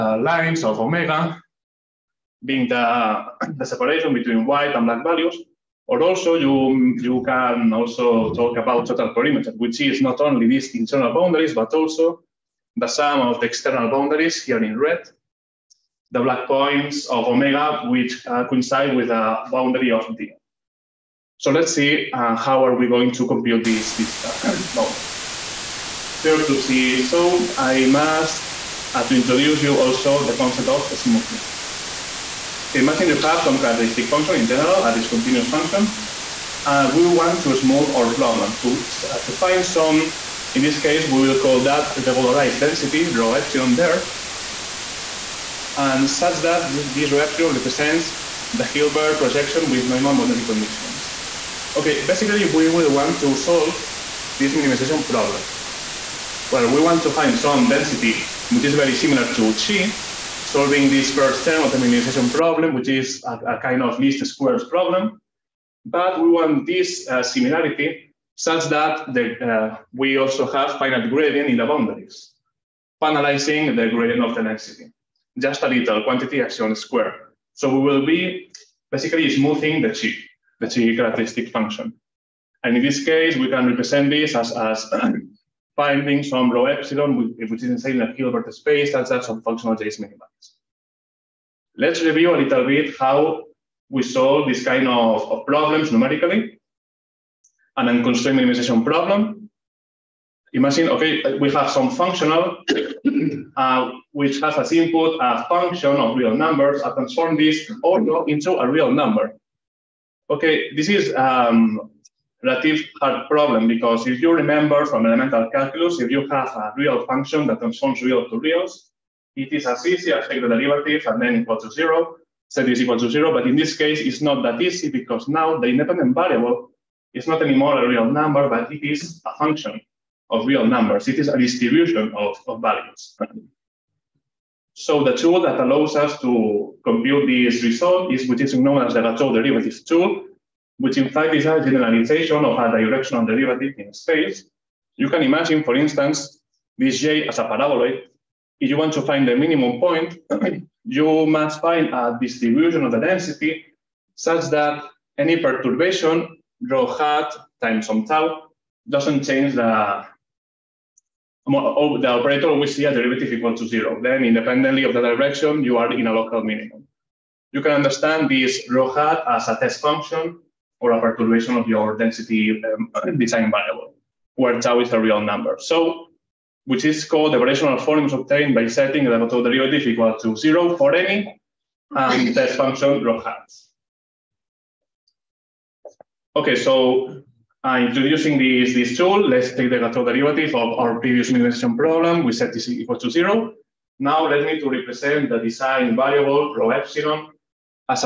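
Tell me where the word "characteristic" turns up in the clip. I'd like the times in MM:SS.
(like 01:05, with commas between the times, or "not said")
00:33, 01:20.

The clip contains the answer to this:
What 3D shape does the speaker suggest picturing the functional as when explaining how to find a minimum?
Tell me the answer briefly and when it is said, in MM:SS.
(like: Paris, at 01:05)
A paraboloid, at 02:27.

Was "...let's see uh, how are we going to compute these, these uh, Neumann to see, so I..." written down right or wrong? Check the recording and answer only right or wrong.
wrong.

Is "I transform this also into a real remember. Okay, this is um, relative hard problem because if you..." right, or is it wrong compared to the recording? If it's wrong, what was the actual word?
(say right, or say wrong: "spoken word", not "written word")
wrong: "number", not "remember".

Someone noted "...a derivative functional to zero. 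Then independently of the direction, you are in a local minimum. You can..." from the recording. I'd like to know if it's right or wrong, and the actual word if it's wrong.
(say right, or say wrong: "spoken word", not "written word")
wrong: "equal", not "functional".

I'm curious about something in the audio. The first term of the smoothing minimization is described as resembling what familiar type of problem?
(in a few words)
Least squares problem.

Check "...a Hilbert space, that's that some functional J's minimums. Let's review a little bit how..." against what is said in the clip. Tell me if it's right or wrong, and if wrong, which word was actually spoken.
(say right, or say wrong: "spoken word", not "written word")
right.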